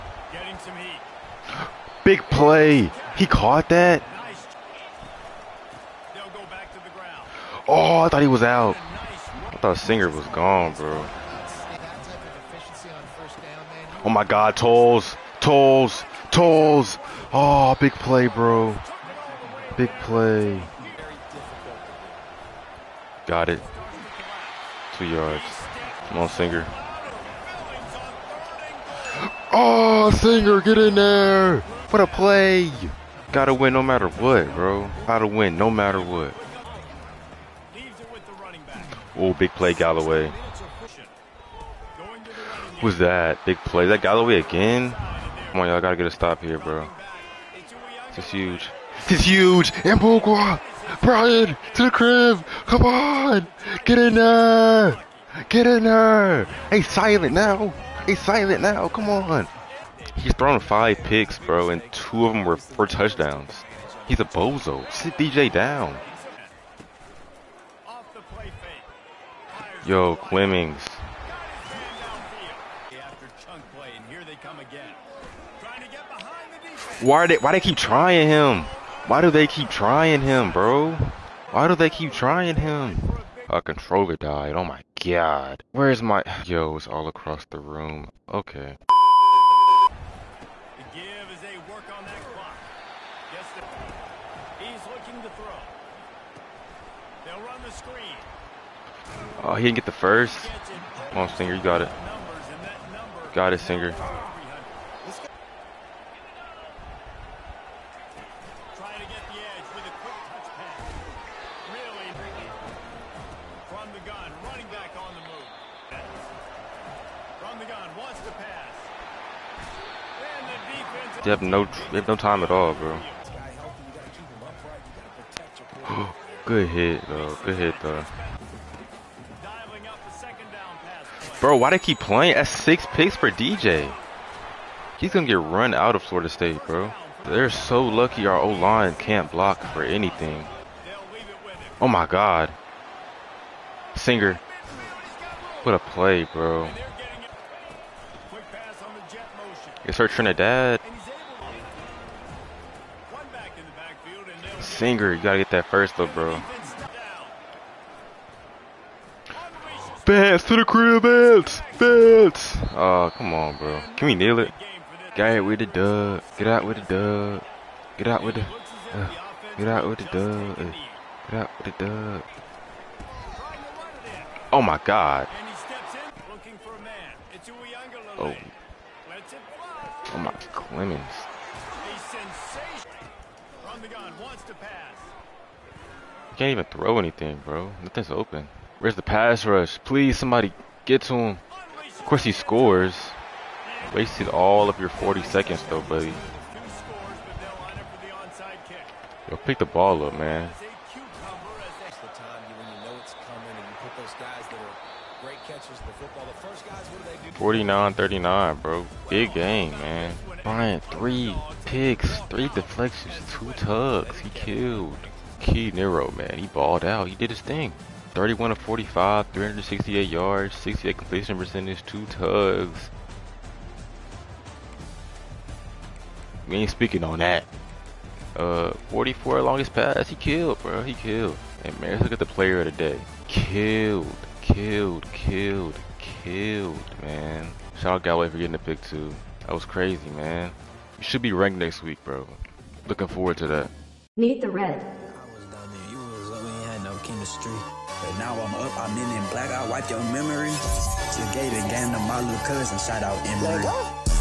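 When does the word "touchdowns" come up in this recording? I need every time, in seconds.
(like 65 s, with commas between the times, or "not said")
62 s.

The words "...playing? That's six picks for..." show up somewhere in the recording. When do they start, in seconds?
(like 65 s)
131 s.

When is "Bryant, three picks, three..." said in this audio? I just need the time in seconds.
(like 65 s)
210 s.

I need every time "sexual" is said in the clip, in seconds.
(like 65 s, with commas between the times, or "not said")
not said.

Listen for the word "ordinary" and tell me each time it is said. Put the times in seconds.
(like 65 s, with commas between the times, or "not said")
not said.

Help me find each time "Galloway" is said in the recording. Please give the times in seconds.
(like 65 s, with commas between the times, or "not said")
39 s, 44 s, 238 s.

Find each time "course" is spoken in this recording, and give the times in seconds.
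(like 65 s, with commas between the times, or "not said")
192 s.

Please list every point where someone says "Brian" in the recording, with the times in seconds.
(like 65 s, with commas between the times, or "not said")
51 s.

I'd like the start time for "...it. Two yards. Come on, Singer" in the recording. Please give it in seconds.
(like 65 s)
23 s.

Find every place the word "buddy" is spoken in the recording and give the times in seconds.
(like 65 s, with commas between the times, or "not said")
195 s.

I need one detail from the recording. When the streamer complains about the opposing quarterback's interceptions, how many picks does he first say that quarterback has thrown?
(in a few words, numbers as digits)
5.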